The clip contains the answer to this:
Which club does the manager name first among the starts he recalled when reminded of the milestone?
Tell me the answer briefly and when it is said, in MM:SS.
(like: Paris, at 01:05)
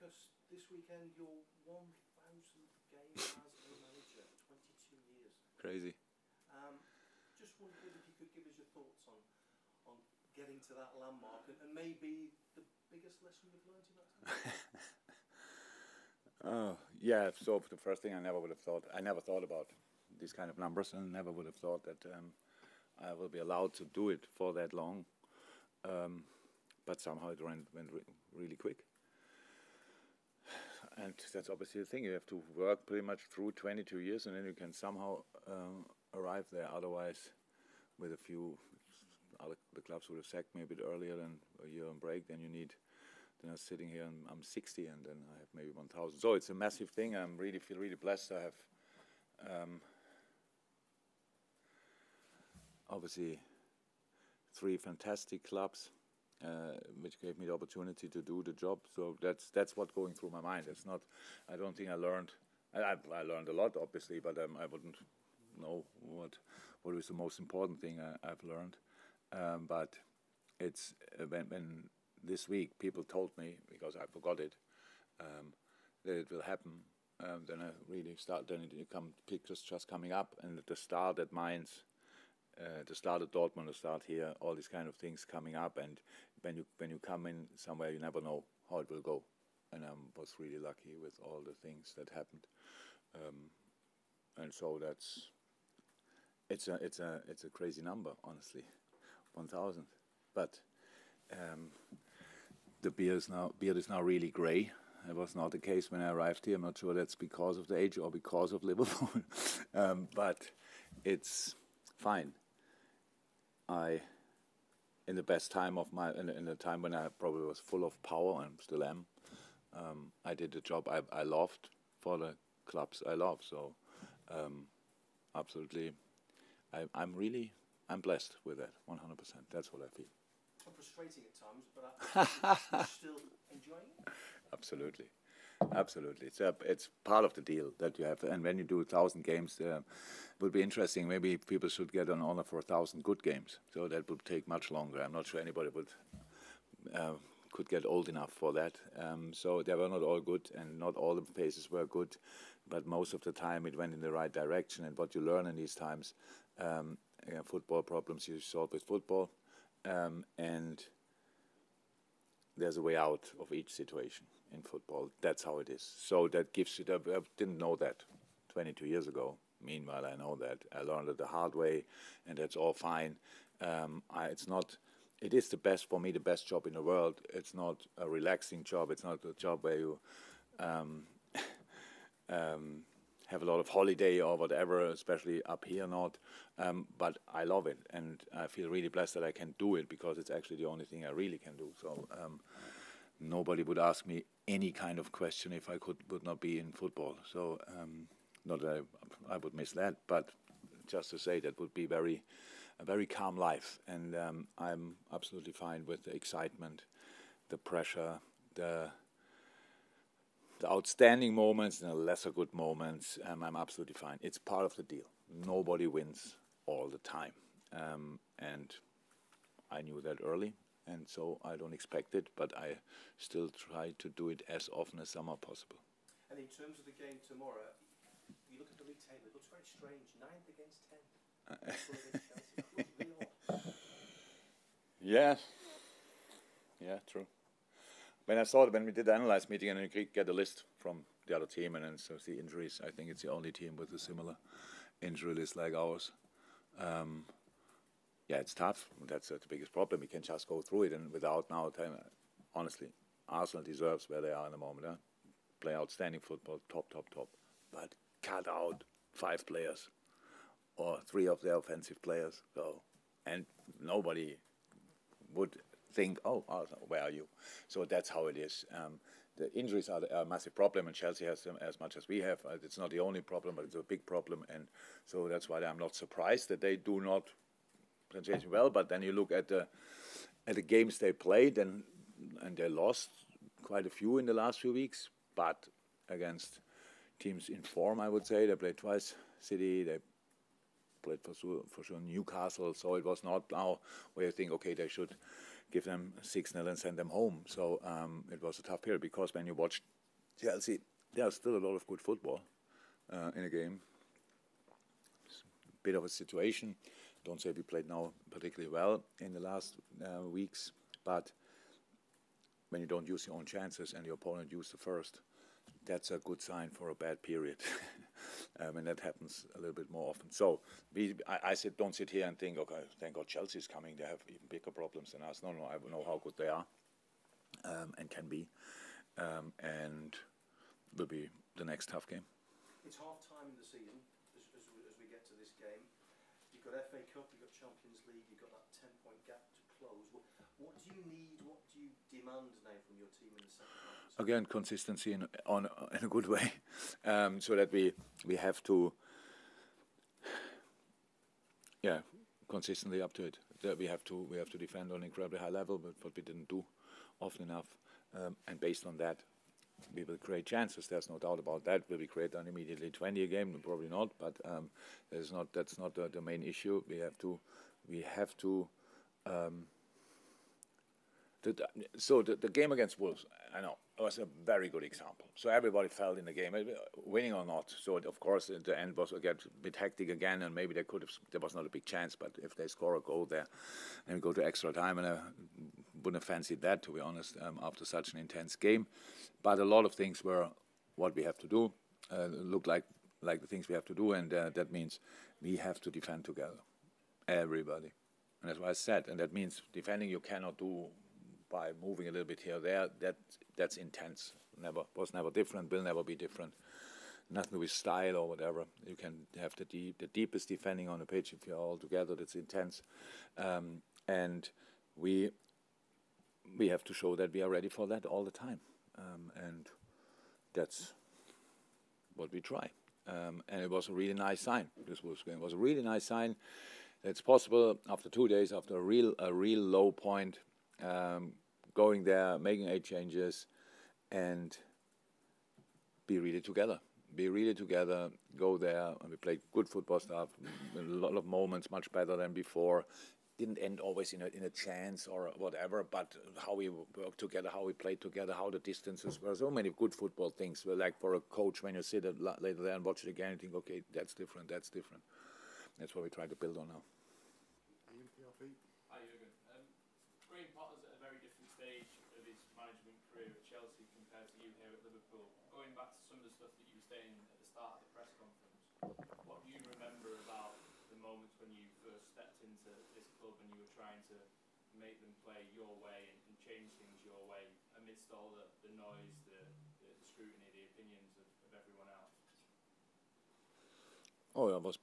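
Mainz, at 01:21.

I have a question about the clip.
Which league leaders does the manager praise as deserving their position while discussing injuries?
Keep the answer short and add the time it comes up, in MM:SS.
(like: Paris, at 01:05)
Arsenal, at 04:13.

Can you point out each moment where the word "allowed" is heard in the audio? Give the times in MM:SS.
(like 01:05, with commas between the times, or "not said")
00:23.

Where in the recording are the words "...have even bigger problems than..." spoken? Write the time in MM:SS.
05:24.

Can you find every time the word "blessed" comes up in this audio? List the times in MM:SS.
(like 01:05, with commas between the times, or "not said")
00:47, 02:08, 03:08.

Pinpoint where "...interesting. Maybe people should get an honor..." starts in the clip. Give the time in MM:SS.
02:20.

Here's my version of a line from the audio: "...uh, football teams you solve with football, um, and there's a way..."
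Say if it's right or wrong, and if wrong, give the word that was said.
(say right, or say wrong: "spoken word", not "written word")
wrong: "problems", not "teams".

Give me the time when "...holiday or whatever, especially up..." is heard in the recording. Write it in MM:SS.
03:03.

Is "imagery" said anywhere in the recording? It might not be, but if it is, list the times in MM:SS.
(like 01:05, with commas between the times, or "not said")
not said.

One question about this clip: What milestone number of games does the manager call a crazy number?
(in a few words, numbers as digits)
1000.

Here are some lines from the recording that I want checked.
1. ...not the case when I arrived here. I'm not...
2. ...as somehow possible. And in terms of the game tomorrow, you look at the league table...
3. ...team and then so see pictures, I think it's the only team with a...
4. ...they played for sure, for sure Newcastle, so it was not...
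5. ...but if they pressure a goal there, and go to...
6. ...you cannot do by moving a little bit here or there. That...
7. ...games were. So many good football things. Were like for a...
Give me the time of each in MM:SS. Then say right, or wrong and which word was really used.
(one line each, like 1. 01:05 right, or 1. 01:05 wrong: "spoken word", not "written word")
1. 01:45 right
2. 03:45 right
3. 04:01 wrong: "injuries", not "pictures"
4. 04:49 right
5. 06:22 wrong: "score", not "pressure"
6. 06:40 right
7. 07:28 wrong: "distances", not "games".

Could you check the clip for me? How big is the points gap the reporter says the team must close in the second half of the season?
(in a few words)
10 points.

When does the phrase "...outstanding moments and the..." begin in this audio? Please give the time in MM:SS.
03:30.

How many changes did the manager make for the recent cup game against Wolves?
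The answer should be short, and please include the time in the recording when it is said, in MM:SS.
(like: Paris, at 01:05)
8, at 07:12.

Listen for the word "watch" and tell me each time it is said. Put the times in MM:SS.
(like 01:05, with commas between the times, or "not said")
04:59, 07:32.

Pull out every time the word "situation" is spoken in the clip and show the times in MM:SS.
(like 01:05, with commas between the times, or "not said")
02:43, 05:06.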